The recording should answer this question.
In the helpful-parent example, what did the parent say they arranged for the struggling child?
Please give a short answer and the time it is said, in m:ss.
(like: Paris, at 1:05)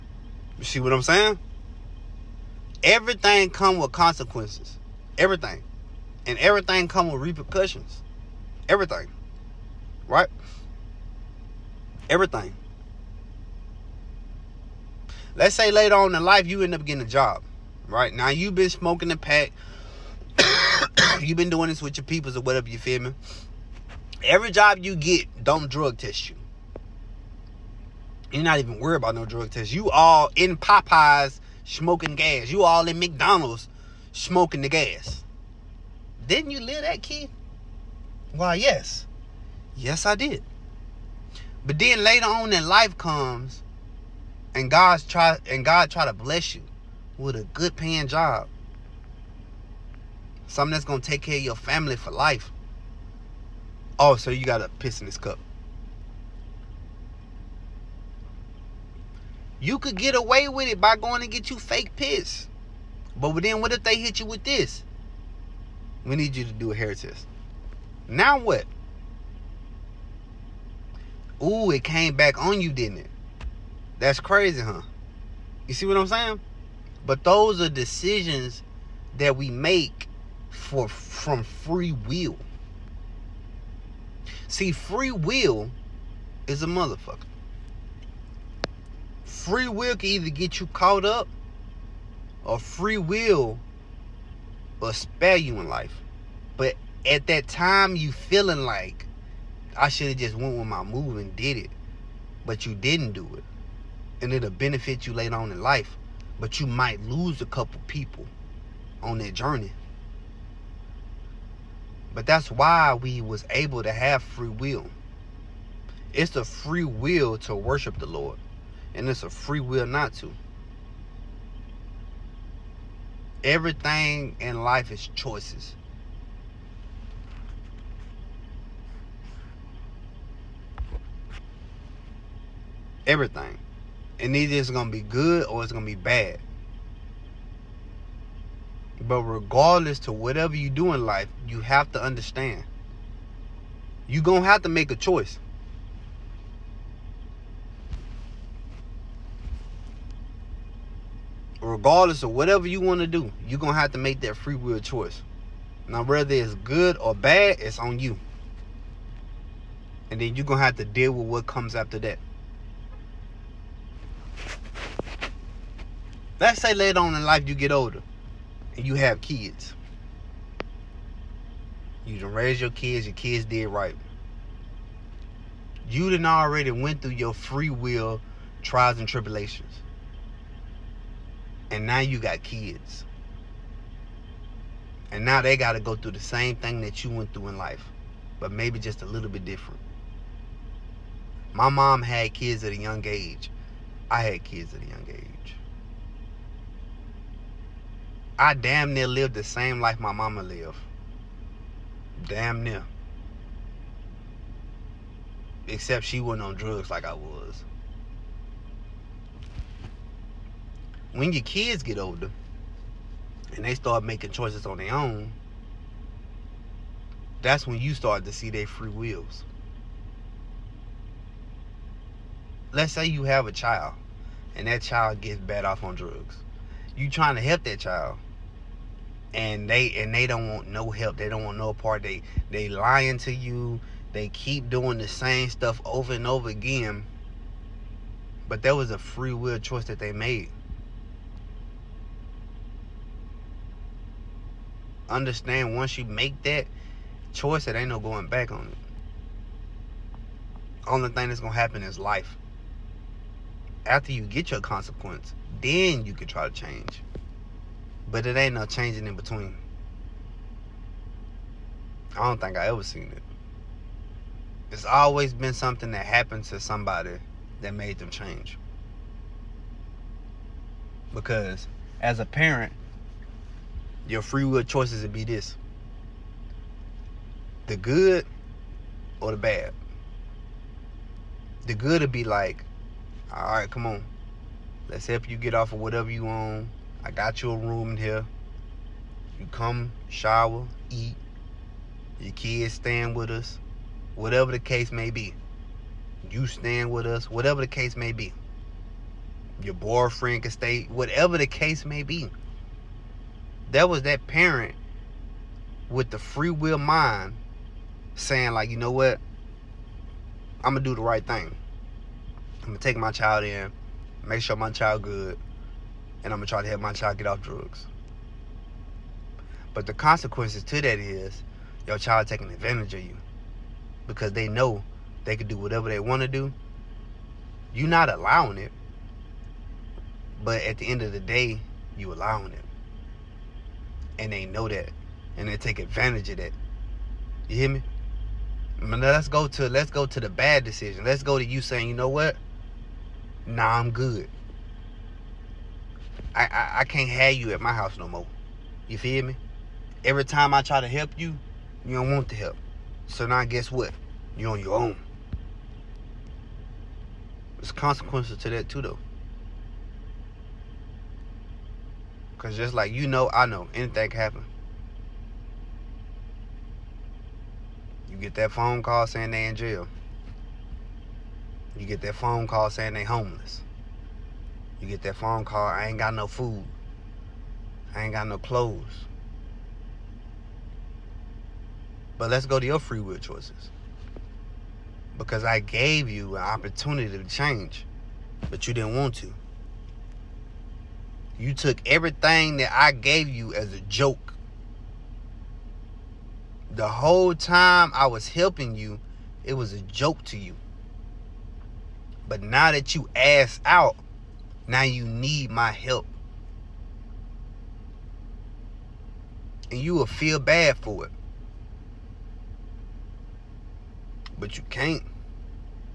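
A room, at 4:47.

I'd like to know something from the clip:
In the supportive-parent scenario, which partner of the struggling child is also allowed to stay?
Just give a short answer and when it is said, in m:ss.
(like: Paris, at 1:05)
Boyfriend, at 4:59.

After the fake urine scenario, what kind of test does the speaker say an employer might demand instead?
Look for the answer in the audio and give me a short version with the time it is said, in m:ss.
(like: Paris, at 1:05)
Hair test, at 1:06.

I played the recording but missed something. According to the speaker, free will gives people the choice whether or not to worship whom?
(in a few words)
The Lord.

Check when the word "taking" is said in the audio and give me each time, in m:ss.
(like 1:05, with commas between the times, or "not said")
5:22.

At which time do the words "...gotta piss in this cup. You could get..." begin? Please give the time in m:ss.
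0:54.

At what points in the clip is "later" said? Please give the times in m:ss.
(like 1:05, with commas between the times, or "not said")
0:15, 0:42, 1:45, 2:46.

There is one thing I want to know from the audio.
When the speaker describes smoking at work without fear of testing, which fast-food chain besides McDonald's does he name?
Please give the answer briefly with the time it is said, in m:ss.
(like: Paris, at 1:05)
Popeyes, at 0:30.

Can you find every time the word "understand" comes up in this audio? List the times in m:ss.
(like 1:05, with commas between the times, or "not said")
2:22, 4:05.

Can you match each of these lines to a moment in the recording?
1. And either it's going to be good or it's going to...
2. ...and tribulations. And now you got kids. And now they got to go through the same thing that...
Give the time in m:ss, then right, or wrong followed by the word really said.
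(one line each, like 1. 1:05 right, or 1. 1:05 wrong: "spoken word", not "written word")
1. 2:14 right
2. 2:58 right.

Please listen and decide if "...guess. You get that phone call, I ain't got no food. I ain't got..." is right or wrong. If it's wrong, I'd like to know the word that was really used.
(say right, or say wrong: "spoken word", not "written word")
wrong: "homeless", not "guess".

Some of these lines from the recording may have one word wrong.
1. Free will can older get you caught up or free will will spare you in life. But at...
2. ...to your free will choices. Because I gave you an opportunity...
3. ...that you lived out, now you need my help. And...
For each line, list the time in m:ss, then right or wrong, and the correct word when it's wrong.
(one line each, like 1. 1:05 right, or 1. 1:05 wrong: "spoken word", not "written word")
1. 1:29 wrong: "either", not "older"
2. 6:22 right
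3. 6:42 wrong: "asked", not "lived".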